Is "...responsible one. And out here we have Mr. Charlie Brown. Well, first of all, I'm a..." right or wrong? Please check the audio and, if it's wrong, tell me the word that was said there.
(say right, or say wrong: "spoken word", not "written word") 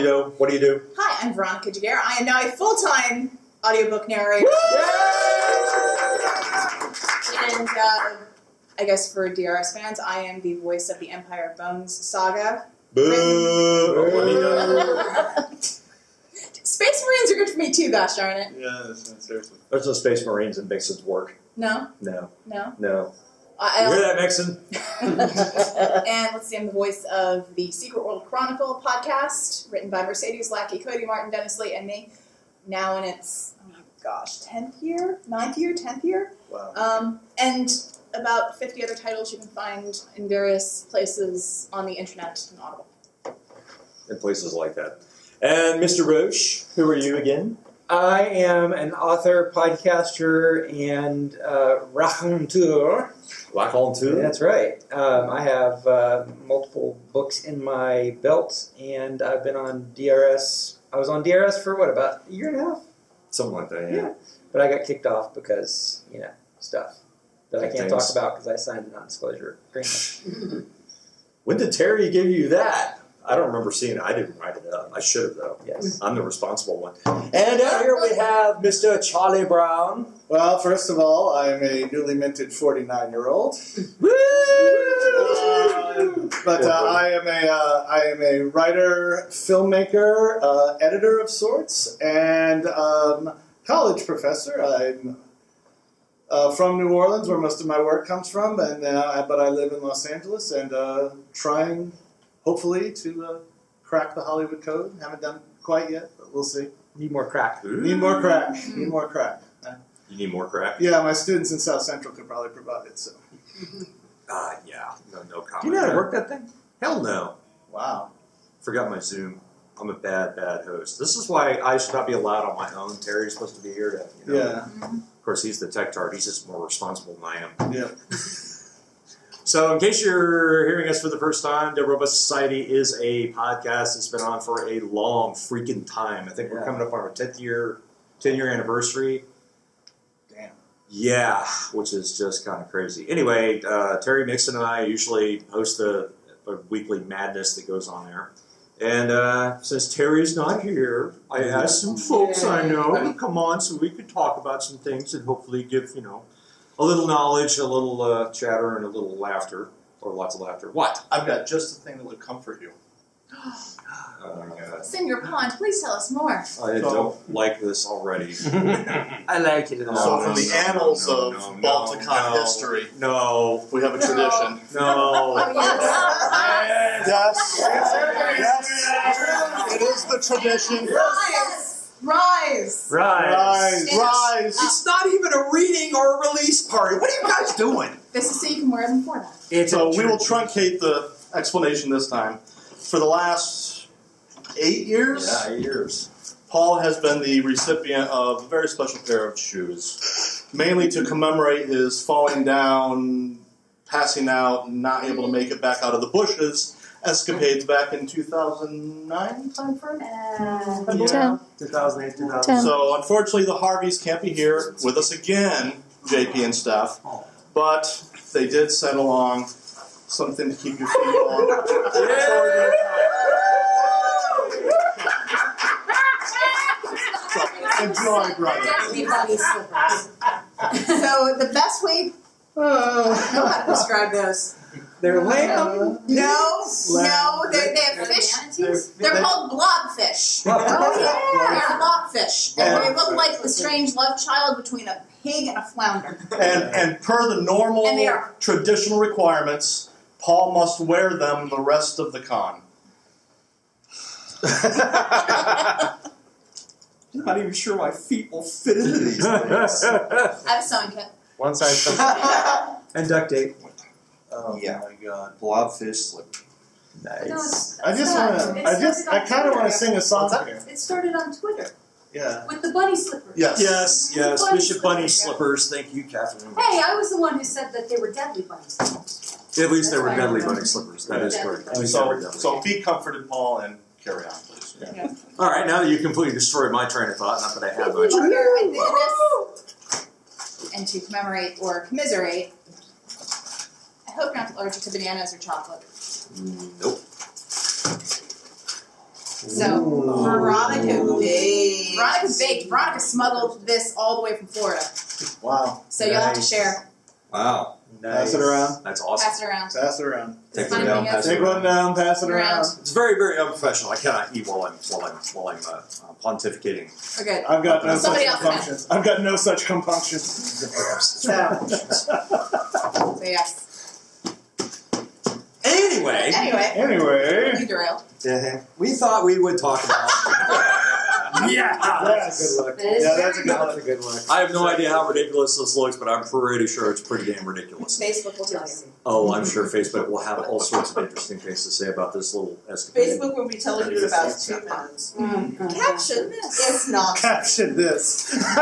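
right.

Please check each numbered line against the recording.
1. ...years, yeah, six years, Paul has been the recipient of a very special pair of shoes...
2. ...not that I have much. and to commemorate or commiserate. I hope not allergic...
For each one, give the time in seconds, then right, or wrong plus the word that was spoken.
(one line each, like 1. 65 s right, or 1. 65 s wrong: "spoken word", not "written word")
1. 194 s wrong: "eight", not "six"
2. 287 s right.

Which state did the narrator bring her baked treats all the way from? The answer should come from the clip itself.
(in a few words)
Florida.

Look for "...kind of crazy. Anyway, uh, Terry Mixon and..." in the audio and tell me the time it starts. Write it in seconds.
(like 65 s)
142 s.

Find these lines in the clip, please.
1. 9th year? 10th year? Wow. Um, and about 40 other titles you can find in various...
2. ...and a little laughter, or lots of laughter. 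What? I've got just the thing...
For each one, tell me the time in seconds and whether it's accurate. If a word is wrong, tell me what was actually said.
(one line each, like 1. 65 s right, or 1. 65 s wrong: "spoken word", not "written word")
1. 35 s wrong: "50", not "40"
2. 158 s right.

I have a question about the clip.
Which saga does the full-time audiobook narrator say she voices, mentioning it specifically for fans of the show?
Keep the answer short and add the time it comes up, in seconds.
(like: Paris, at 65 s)
Empire Bones saga, at 11 s.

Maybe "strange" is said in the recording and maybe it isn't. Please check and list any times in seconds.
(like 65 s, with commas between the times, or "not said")
243 s.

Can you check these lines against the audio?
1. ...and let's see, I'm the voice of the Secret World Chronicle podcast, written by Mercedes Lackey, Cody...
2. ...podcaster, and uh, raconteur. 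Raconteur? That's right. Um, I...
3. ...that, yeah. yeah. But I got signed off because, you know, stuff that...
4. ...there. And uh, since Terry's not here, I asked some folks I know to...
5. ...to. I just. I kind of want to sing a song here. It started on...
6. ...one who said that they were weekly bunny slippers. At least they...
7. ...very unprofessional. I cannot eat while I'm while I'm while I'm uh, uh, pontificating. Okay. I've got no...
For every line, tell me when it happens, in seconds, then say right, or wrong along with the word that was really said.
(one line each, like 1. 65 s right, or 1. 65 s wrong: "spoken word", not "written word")
1. 25 s right
2. 49 s right
3. 63 s wrong: "kicked", not "signed"
4. 148 s right
5. 268 s right
6. 277 s wrong: "deadly", not "weekly"
7. 313 s right.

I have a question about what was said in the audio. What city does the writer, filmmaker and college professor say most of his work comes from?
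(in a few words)
New Orleans.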